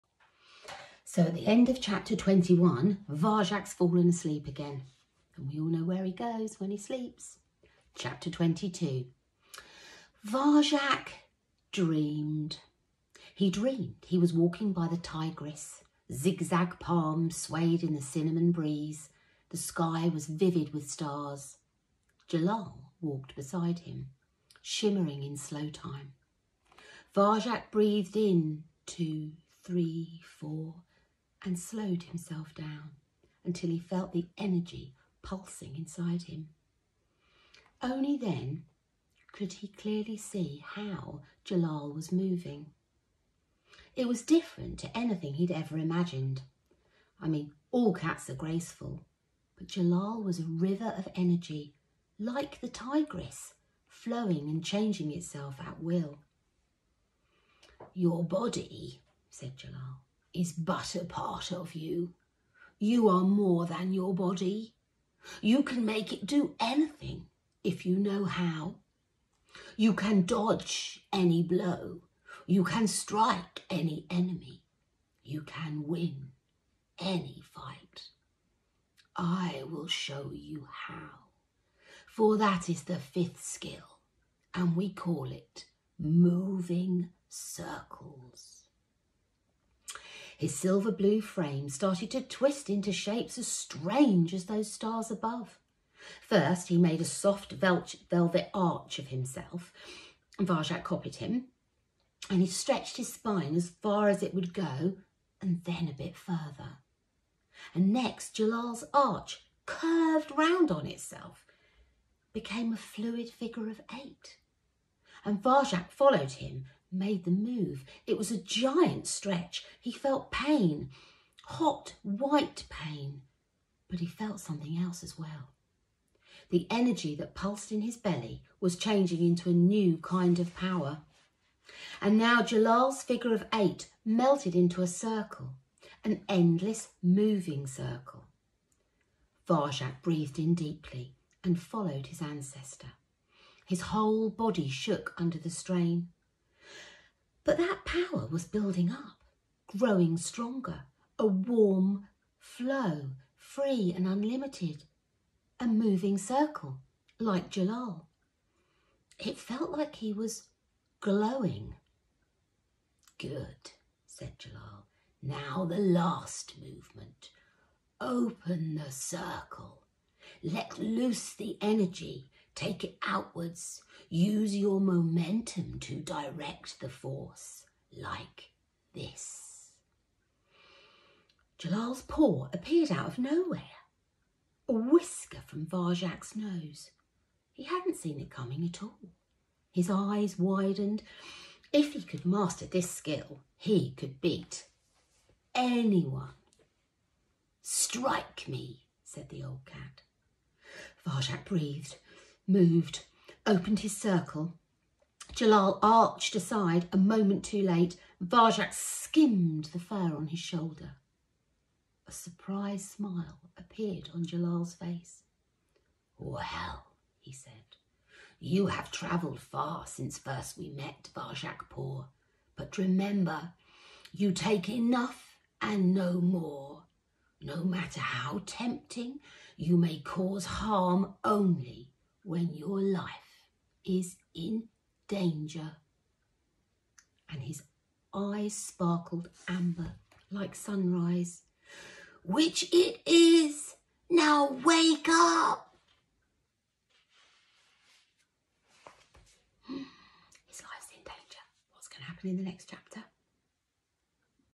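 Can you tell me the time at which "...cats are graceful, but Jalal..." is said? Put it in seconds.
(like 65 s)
47 s.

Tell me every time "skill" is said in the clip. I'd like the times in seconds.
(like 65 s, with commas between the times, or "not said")
83 s, 192 s.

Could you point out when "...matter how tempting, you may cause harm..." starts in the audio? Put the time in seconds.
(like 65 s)
227 s.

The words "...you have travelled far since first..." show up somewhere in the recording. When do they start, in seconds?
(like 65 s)
218 s.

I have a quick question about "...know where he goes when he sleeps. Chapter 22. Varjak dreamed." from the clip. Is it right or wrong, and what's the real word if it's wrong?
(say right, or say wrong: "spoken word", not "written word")
right.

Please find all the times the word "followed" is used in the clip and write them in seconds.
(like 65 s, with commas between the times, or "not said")
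115 s, 141 s.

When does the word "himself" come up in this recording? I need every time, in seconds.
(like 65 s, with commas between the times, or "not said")
32 s, 99 s.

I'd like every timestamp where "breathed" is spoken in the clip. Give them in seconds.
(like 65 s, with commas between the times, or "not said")
27 s, 140 s, 201 s.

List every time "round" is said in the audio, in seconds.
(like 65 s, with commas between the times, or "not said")
110 s.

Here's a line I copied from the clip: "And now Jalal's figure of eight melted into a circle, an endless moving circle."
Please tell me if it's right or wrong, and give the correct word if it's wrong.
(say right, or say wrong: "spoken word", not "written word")
right.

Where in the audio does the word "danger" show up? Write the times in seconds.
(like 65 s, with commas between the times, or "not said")
235 s, 251 s.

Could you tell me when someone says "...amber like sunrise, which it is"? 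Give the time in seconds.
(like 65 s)
239 s.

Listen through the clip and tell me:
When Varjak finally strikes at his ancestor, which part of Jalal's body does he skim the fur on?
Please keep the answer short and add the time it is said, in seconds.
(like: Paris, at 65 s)
Shoulder, at 210 s.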